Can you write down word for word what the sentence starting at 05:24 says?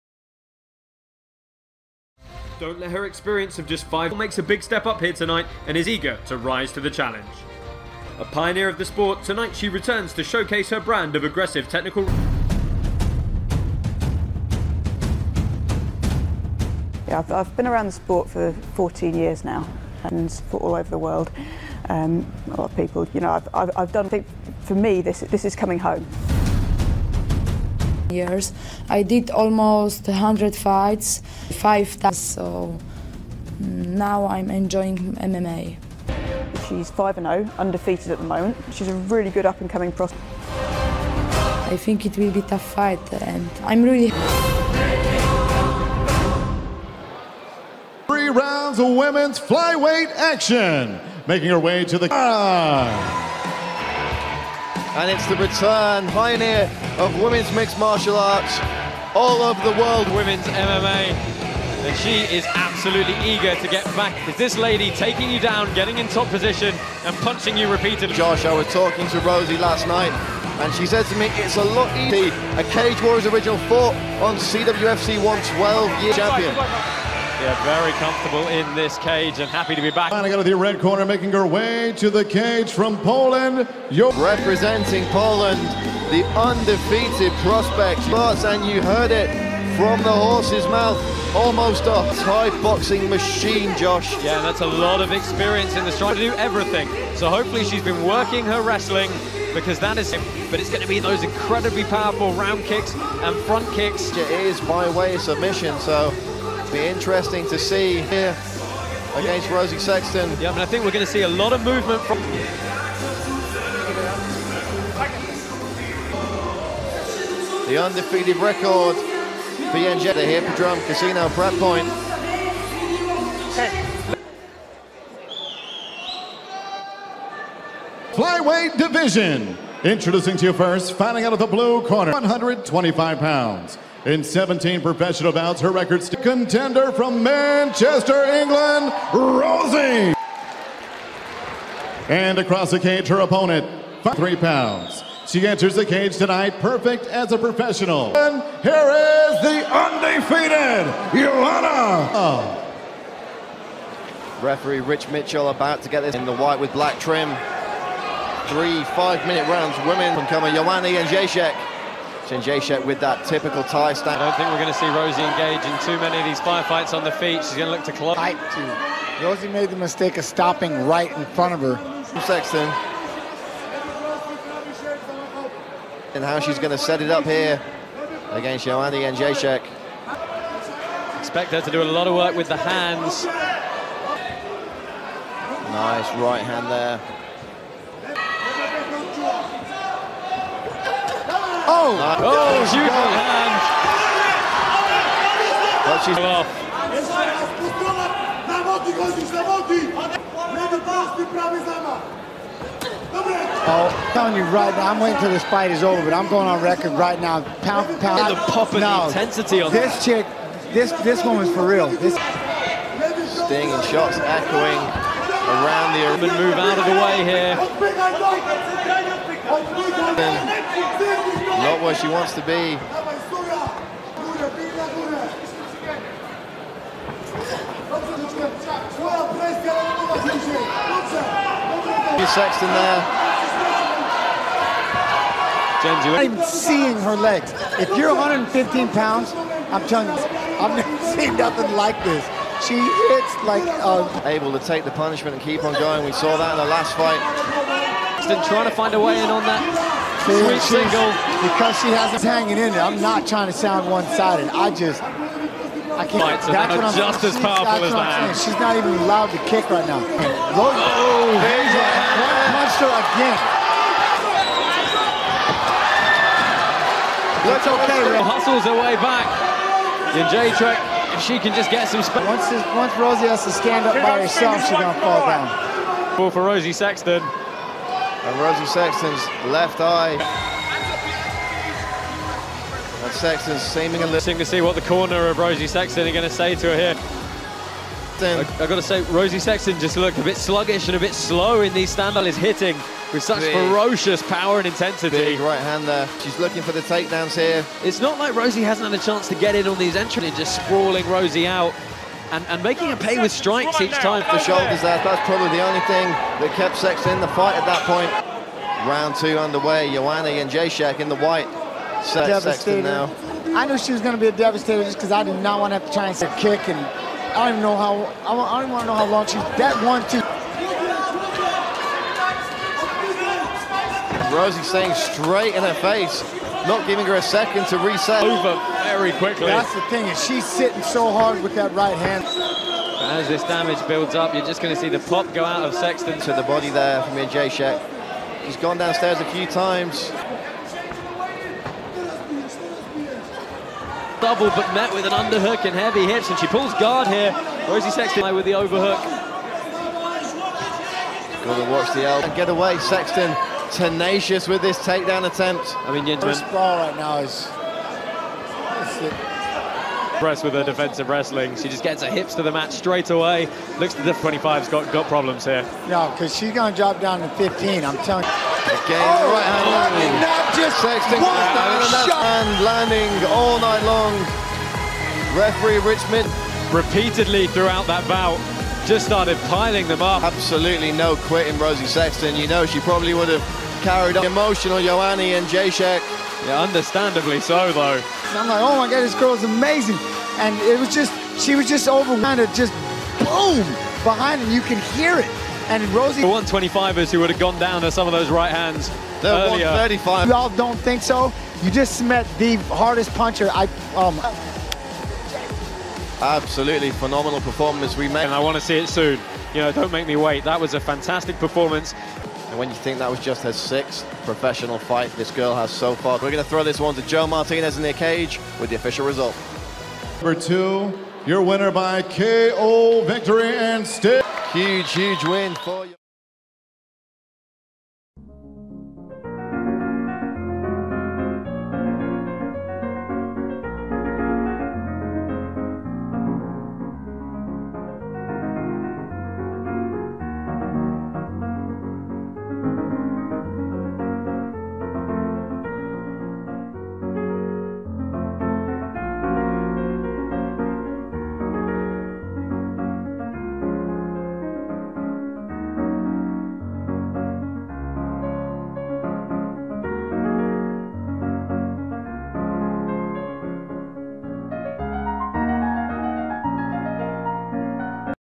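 Rosi staying straight in her face not giving her a second to reset.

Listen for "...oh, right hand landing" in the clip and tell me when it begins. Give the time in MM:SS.
06:09.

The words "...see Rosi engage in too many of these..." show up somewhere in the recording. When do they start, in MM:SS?
02:44.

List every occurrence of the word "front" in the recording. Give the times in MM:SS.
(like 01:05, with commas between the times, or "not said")
01:43, 02:51.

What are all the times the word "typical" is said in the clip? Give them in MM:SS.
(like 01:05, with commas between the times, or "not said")
02:43.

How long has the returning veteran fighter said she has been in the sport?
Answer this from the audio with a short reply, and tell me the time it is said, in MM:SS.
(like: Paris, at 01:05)
14 years, at 00:18.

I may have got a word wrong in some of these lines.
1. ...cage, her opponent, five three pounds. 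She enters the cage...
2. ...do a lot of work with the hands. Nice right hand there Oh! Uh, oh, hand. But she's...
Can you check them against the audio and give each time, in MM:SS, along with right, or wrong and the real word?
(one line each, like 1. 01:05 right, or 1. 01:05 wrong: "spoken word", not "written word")
1. 02:22 right
2. 03:01 right.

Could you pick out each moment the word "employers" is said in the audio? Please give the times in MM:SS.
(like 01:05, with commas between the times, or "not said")
not said.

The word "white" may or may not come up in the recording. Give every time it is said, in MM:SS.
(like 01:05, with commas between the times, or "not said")
02:36, 05:11.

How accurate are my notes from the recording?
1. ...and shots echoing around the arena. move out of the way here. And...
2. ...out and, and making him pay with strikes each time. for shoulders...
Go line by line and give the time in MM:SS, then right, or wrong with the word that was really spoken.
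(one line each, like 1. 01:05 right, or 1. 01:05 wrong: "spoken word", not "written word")
1. 03:33 right
2. 05:01 right.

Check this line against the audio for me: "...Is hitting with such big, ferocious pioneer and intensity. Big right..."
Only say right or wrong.
wrong.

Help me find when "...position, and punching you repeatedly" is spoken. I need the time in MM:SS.
01:06.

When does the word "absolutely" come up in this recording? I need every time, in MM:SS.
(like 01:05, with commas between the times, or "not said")
01:02, 06:20, 06:46.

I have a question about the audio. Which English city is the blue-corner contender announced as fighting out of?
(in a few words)
Manchester.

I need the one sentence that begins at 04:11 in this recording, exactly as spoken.
Because she has hanging in it.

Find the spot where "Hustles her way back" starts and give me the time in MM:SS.
04:28.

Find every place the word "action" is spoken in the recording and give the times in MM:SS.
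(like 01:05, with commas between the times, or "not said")
00:50.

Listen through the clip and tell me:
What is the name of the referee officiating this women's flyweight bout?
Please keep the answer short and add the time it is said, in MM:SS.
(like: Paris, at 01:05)
Rich Mitchell, at 02:34.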